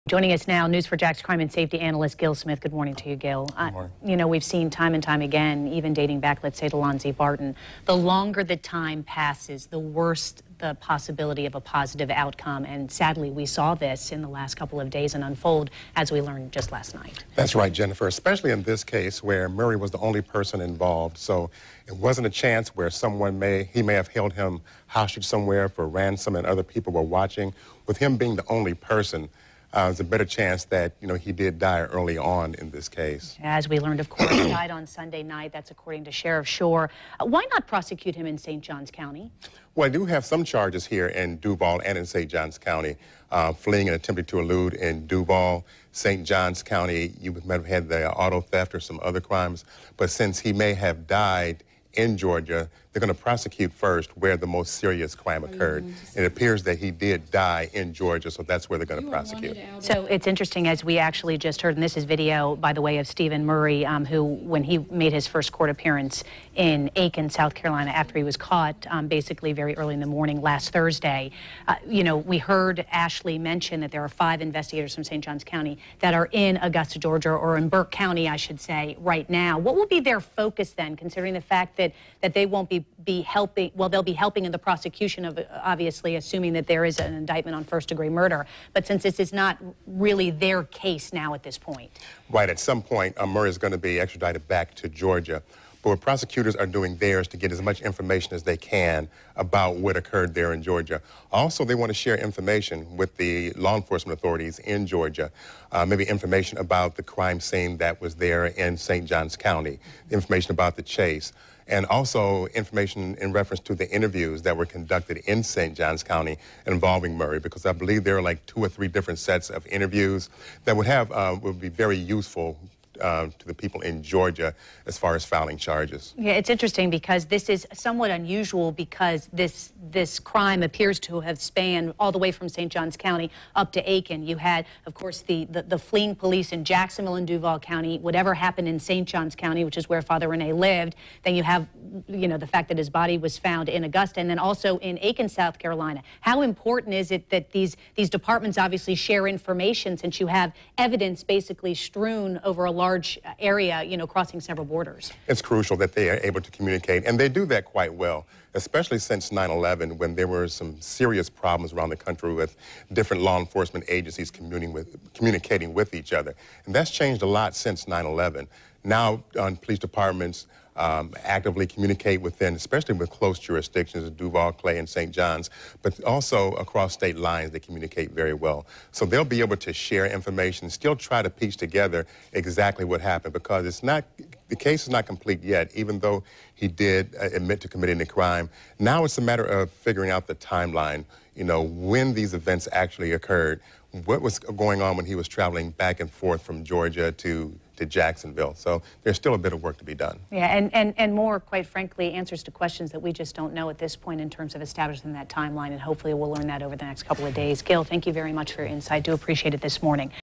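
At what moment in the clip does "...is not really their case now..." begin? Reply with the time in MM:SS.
01:29.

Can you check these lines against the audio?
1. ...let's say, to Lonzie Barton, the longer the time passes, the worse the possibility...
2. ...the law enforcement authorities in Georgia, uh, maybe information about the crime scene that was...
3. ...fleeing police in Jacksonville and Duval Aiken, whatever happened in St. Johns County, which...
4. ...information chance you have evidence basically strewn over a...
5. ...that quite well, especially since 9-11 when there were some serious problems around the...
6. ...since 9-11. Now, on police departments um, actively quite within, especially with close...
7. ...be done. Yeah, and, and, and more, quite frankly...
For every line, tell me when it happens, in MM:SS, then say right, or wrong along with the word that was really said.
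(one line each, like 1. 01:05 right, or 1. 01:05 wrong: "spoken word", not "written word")
1. 00:06 right
2. 01:43 right
3. 02:15 wrong: "County", not "Aiken"
4. 02:29 wrong: "since", not "chance"
5. 02:37 right
6. 02:47 wrong: "communicate", not "quite"
7. 03:19 right.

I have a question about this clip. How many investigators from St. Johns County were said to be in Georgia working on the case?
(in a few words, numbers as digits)
5.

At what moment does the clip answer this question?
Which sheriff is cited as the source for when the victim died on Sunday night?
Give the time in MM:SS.
00:36.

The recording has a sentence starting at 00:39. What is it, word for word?
Well, I do have some charges here in Duval and in St.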